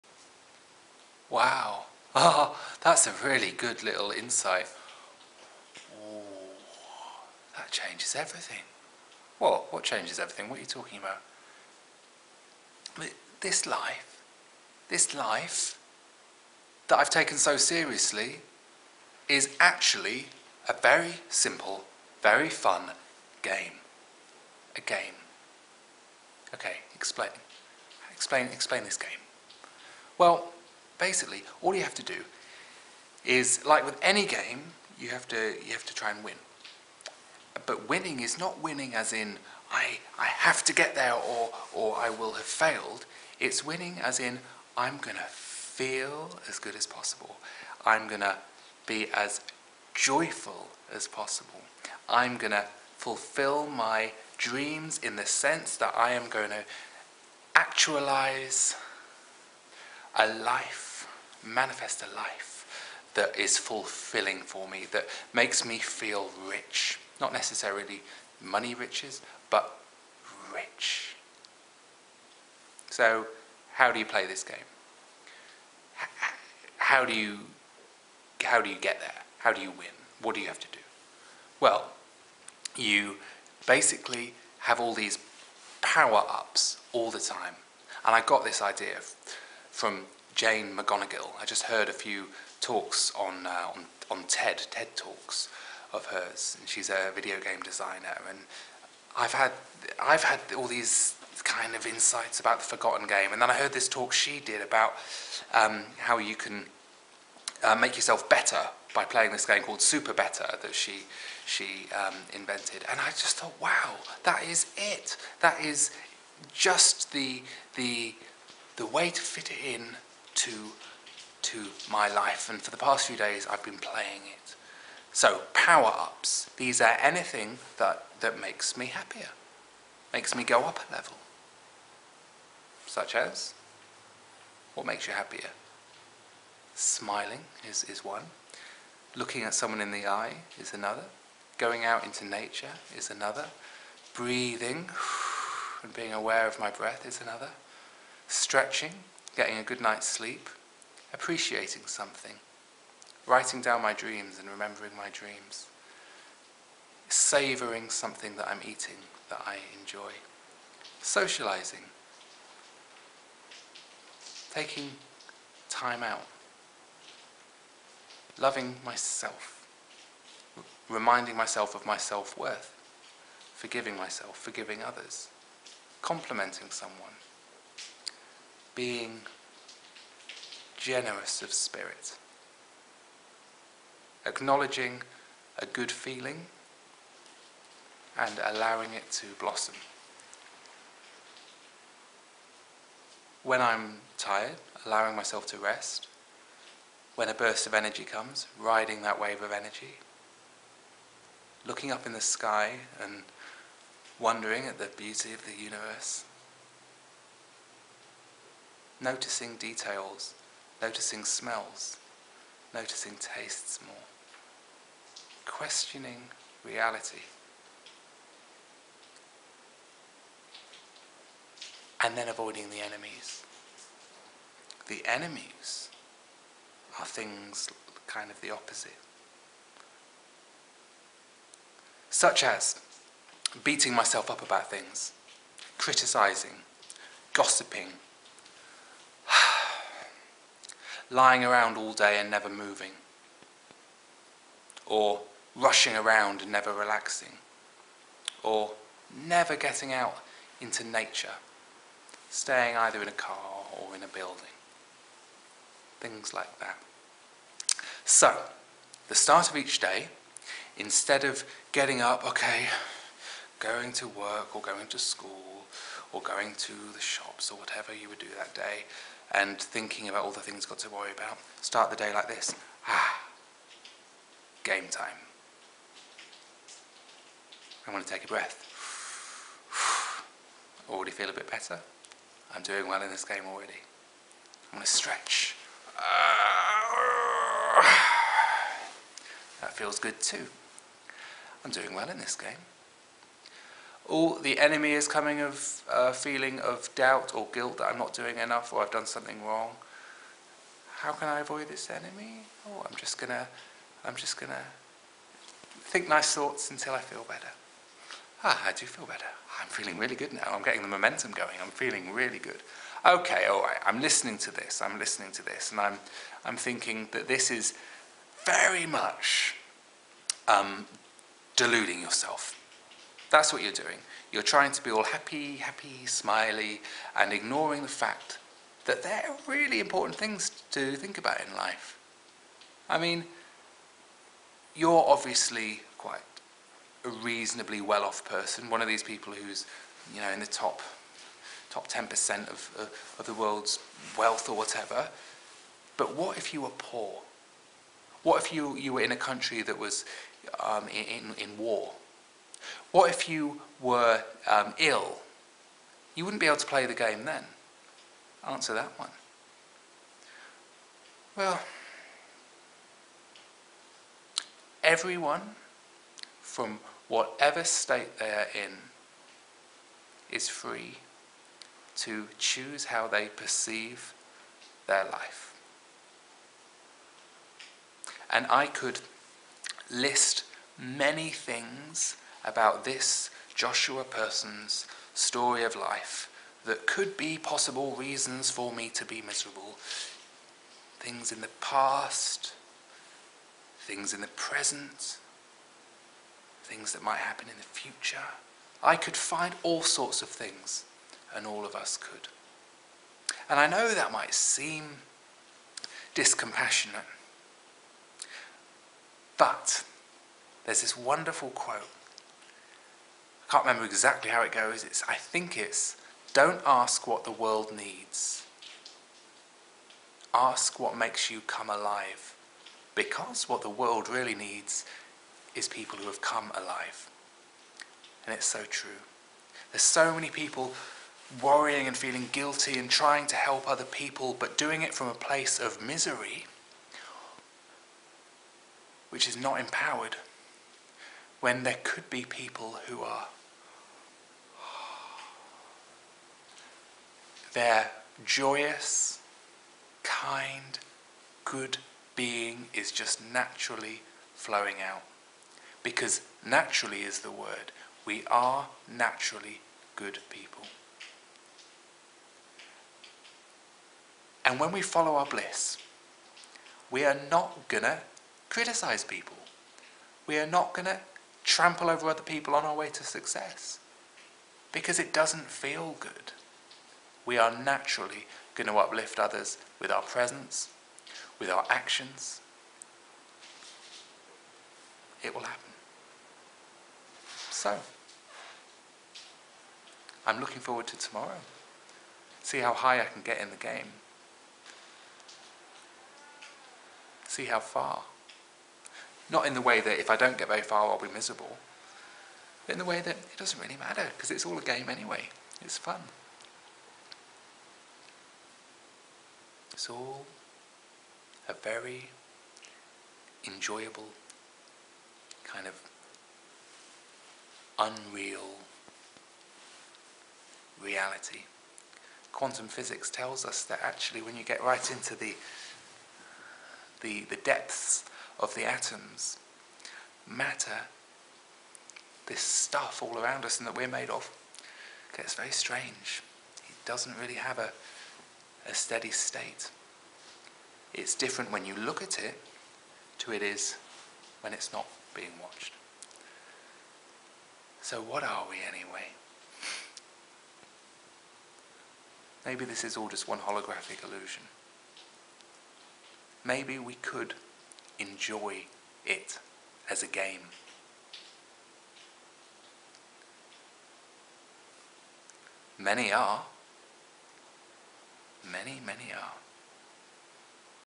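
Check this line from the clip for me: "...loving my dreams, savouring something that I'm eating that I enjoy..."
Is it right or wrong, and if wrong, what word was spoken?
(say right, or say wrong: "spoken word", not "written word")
wrong: "remembering", not "loving".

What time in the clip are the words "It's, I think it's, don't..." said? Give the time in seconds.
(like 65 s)
414 s.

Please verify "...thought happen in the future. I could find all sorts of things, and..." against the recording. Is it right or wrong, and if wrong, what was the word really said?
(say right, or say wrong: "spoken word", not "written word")
wrong: "might", not "thought".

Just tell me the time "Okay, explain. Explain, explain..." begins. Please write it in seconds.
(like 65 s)
26 s.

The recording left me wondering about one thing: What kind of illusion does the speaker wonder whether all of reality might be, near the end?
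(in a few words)
Holographic.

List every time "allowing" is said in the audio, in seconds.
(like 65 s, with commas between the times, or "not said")
188 s, 194 s.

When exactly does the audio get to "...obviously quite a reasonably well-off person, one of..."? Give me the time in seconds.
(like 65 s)
335 s.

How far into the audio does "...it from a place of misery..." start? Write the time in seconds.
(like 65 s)
434 s.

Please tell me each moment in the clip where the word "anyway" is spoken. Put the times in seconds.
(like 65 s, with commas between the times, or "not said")
504 s, 548 s.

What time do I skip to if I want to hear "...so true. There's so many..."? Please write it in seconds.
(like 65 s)
428 s.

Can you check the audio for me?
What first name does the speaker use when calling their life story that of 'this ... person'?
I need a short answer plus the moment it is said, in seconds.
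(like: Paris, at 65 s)
Joshua, at 383 s.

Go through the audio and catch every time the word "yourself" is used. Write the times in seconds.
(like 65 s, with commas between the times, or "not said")
107 s, 322 s.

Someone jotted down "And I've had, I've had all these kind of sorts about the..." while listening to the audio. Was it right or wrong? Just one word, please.
wrong.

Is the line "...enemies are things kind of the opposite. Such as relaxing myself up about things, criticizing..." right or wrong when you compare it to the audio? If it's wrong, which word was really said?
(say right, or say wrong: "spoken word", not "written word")
wrong: "beating", not "relaxing".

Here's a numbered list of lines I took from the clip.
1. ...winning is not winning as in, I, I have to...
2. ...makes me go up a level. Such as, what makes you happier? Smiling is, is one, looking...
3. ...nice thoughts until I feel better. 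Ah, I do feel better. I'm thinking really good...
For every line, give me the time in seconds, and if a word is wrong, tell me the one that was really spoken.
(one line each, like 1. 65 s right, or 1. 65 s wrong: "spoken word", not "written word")
1. 37 s right
2. 130 s right
3. 306 s wrong: "feeling", not "thinking".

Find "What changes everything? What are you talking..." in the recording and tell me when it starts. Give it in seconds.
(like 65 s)
9 s.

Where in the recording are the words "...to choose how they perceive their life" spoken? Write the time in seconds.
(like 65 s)
371 s.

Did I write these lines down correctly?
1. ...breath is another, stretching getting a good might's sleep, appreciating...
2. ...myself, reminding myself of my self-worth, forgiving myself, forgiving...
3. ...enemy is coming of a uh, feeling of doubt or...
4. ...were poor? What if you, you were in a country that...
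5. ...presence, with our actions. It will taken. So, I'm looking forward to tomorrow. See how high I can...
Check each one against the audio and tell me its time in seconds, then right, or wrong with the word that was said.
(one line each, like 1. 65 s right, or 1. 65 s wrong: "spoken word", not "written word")
1. 146 s wrong: "night", not "might"
2. 168 s right
3. 294 s right
4. 346 s right
5. 480 s wrong: "happen", not "taken".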